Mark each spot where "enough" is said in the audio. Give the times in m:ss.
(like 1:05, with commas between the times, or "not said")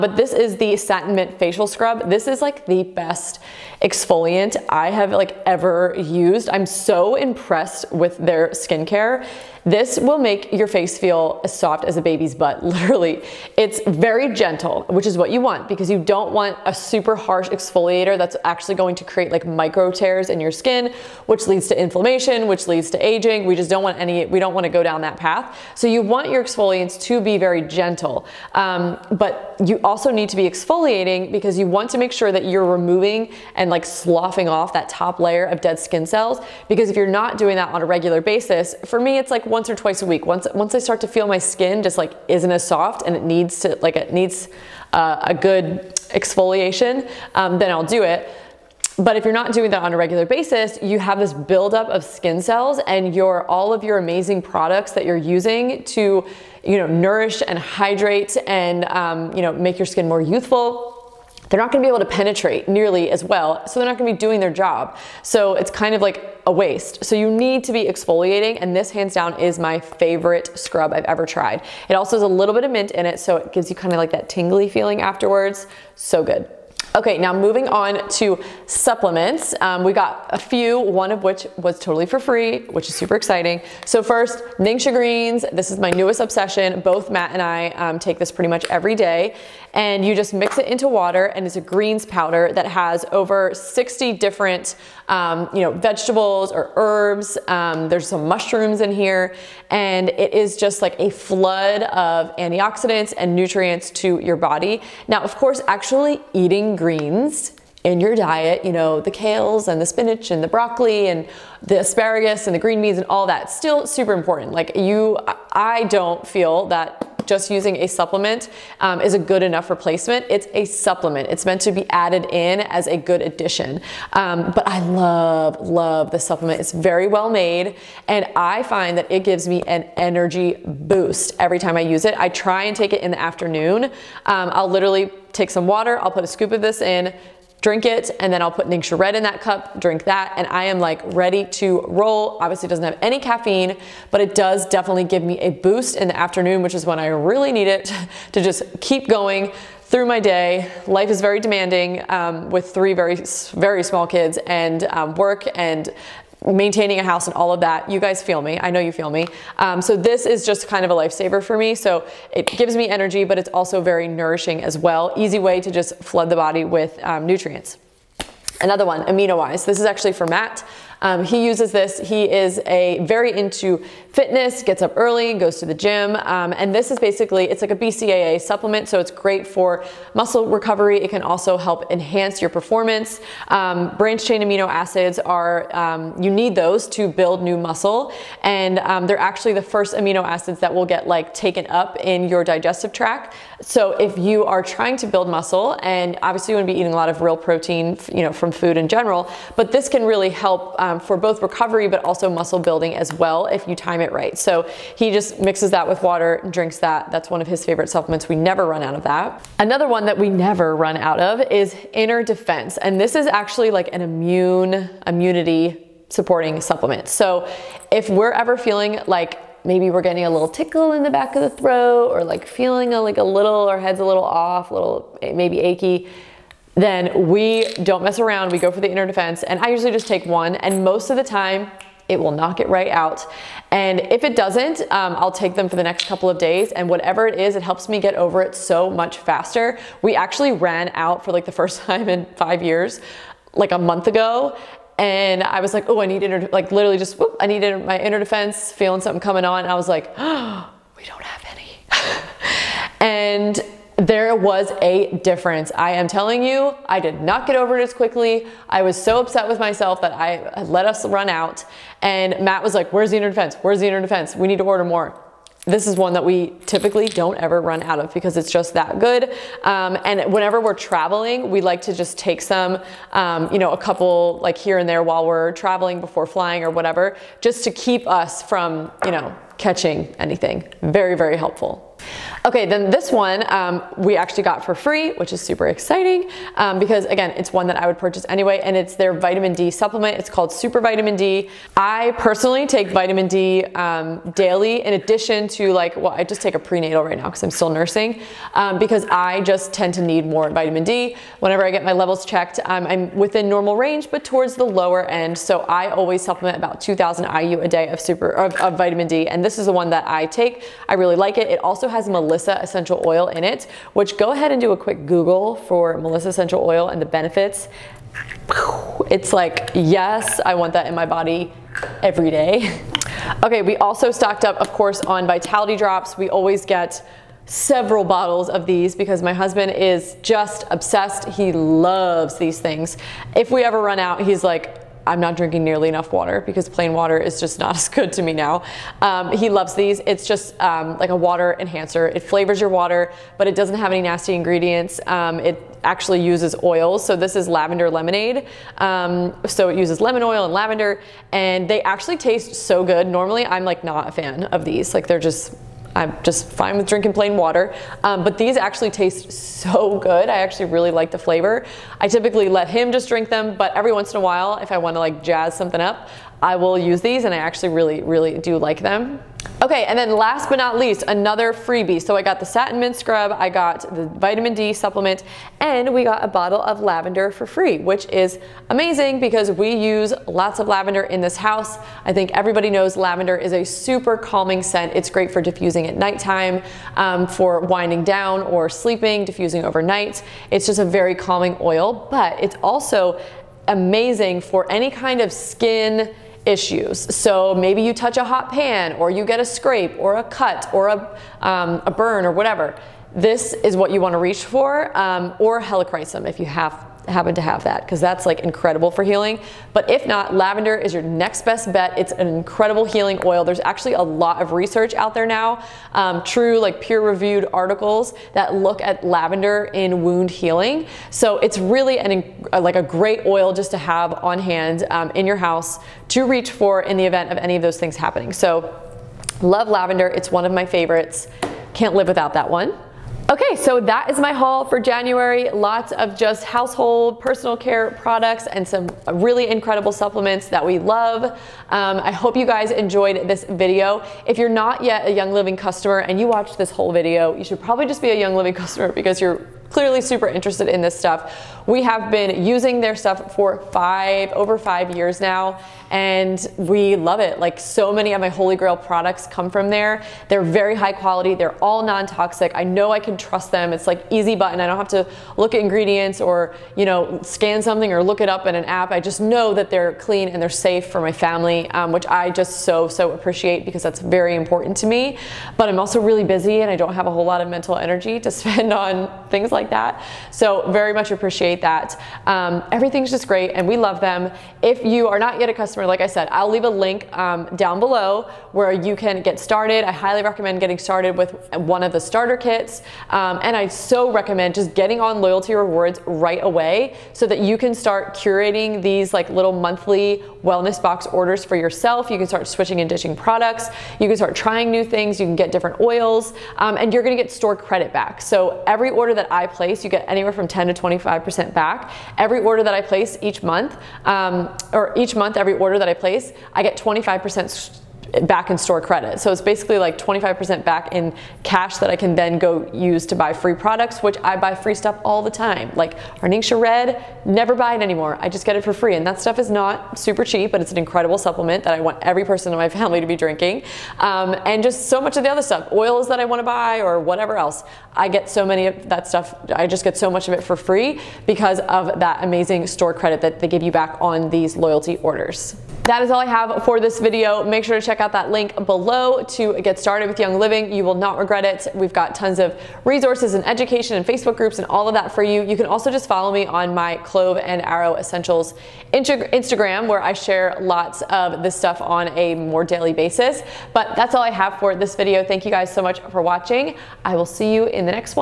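1:59, 5:35.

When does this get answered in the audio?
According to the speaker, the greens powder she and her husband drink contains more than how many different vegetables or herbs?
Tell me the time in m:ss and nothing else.
1:33.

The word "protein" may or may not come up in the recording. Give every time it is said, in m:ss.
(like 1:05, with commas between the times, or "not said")
3:17.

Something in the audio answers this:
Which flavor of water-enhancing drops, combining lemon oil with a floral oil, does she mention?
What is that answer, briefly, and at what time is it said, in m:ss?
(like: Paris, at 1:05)
Lavender lemonade, at 5:47.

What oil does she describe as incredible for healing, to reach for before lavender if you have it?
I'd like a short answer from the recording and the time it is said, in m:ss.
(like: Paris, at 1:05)
Helichrysum, at 6:45.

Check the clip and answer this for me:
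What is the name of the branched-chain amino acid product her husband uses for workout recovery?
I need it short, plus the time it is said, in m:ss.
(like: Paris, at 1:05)
AminoWise, at 2:49.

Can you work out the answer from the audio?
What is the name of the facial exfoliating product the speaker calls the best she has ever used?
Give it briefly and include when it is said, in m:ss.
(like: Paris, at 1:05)
Satin Mint Facial Scrub, at 0:00.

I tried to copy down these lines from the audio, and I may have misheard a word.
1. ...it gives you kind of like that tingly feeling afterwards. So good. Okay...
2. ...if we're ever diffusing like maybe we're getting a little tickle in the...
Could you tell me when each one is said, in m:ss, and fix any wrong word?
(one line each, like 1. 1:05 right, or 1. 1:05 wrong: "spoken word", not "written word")
1. 1:13 right
2. 3:37 wrong: "feeling", not "diffusing".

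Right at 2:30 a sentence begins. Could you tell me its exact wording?
Life is very demanding um, with three very, very small kids and um, work and maintaining a house and all of that.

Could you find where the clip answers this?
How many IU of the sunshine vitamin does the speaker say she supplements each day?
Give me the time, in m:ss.
5:06.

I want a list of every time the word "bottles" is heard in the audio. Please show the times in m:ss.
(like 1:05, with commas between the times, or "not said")
5:28, 6:16.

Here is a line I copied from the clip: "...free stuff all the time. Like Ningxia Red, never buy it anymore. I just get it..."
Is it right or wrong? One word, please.
right.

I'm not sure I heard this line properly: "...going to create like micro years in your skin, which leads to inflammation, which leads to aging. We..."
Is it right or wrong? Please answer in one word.
wrong.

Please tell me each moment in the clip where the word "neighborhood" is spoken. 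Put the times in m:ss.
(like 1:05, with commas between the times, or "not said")
not said.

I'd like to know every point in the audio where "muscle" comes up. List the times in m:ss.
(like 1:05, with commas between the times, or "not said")
3:00, 3:07, 3:15, 3:22.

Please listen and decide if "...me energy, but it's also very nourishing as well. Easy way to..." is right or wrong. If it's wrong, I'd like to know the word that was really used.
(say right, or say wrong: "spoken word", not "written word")
right.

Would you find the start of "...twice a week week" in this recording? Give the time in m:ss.
0:39.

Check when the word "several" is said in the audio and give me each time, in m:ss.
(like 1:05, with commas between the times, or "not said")
5:27.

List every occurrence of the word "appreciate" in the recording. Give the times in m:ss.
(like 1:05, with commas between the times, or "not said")
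7:53, 8:01.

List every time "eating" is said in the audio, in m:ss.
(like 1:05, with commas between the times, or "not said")
1:46, 3:16.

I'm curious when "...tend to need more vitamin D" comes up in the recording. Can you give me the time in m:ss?
4:59.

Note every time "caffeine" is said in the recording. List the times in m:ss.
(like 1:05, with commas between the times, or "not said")
2:23.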